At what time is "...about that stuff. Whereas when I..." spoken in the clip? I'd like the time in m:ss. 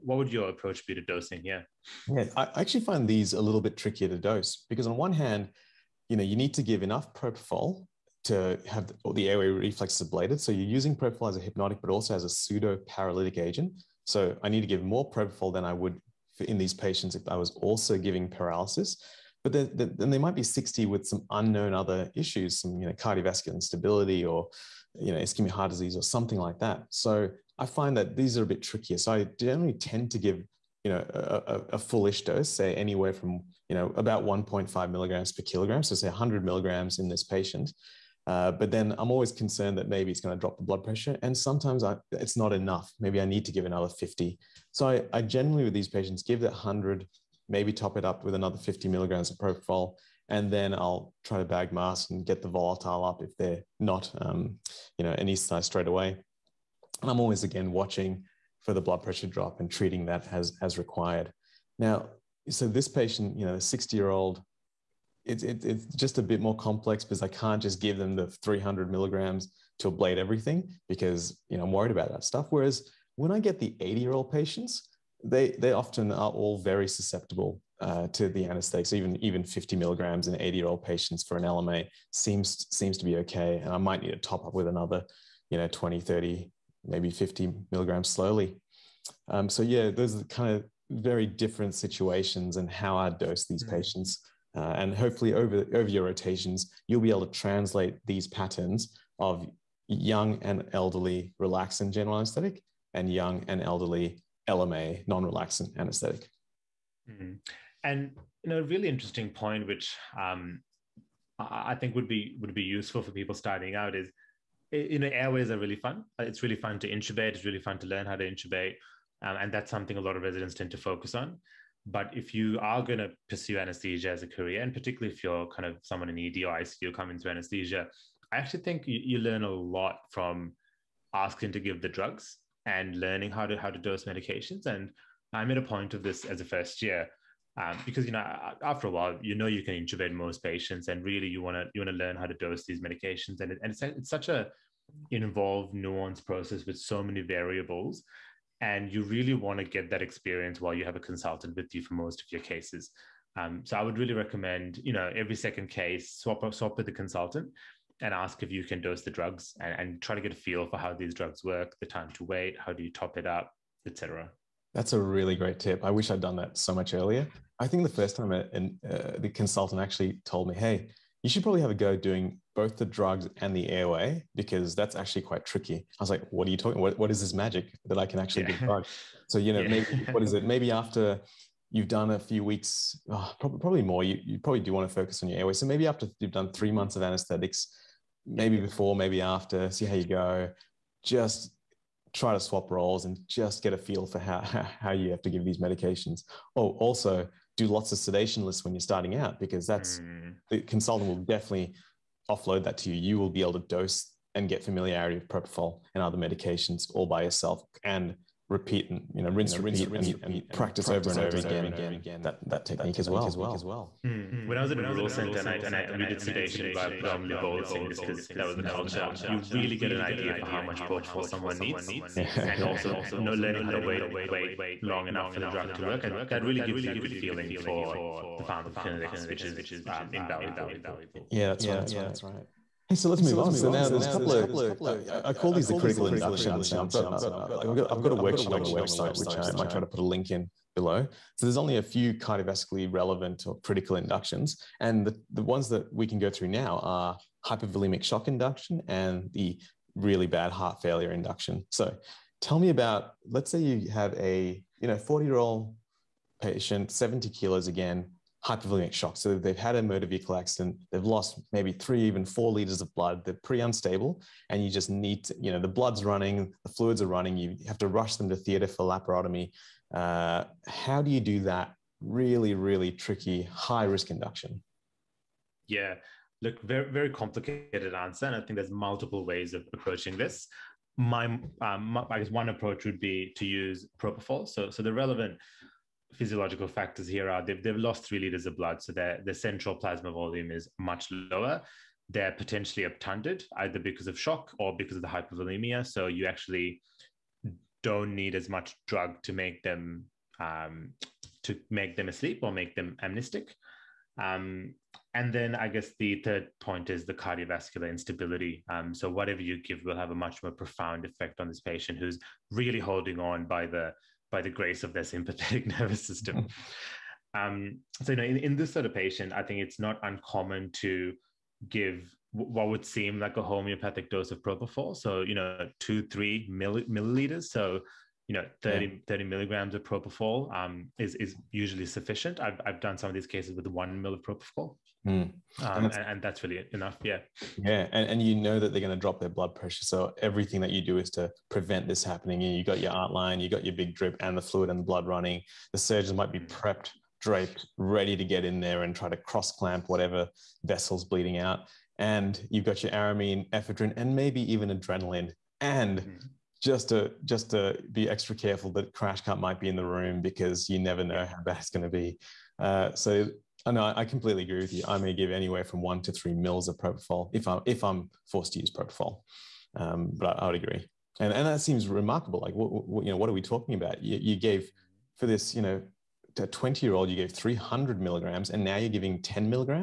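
1:11.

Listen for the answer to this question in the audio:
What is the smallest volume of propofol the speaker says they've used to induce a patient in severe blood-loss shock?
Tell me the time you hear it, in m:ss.
5:33.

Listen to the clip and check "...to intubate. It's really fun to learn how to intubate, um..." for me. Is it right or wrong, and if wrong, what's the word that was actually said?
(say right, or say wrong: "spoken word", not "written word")
right.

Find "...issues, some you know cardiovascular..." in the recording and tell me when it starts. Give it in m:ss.
0:22.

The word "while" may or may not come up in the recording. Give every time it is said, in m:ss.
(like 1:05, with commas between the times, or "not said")
2:18, 2:30.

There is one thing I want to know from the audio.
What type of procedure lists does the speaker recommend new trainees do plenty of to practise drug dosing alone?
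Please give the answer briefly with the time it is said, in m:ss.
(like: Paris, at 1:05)
sedation lists, at 3:17.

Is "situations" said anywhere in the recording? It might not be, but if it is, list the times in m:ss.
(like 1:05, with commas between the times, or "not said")
1:31.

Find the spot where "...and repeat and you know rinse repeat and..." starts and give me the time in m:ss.
3:27.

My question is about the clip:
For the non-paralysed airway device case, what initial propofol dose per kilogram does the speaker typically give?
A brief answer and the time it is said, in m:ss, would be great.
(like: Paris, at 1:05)
1.5 mg/kg, at 0:34.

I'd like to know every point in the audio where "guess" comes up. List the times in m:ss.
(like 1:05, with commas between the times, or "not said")
4:42, 5:05.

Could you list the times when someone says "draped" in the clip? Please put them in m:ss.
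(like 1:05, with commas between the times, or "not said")
5:47.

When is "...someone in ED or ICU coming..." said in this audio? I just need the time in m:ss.
2:05.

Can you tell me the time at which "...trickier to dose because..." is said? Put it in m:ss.
0:03.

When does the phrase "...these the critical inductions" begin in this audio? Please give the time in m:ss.
3:55.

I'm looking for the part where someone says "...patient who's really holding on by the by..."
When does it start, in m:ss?
5:11.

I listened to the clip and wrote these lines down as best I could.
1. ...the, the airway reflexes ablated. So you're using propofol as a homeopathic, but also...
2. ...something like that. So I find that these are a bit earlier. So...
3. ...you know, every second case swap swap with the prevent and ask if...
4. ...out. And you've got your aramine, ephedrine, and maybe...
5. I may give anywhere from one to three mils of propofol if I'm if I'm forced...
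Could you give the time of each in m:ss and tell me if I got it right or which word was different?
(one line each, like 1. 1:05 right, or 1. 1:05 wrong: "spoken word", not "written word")
1. 0:08 wrong: "hypnotic", not "homeopathic"
2. 0:26 wrong: "trickier", not "earlier"
3. 2:34 wrong: "consultant", not "prevent"
4. 5:51 right
5. 6:04 right.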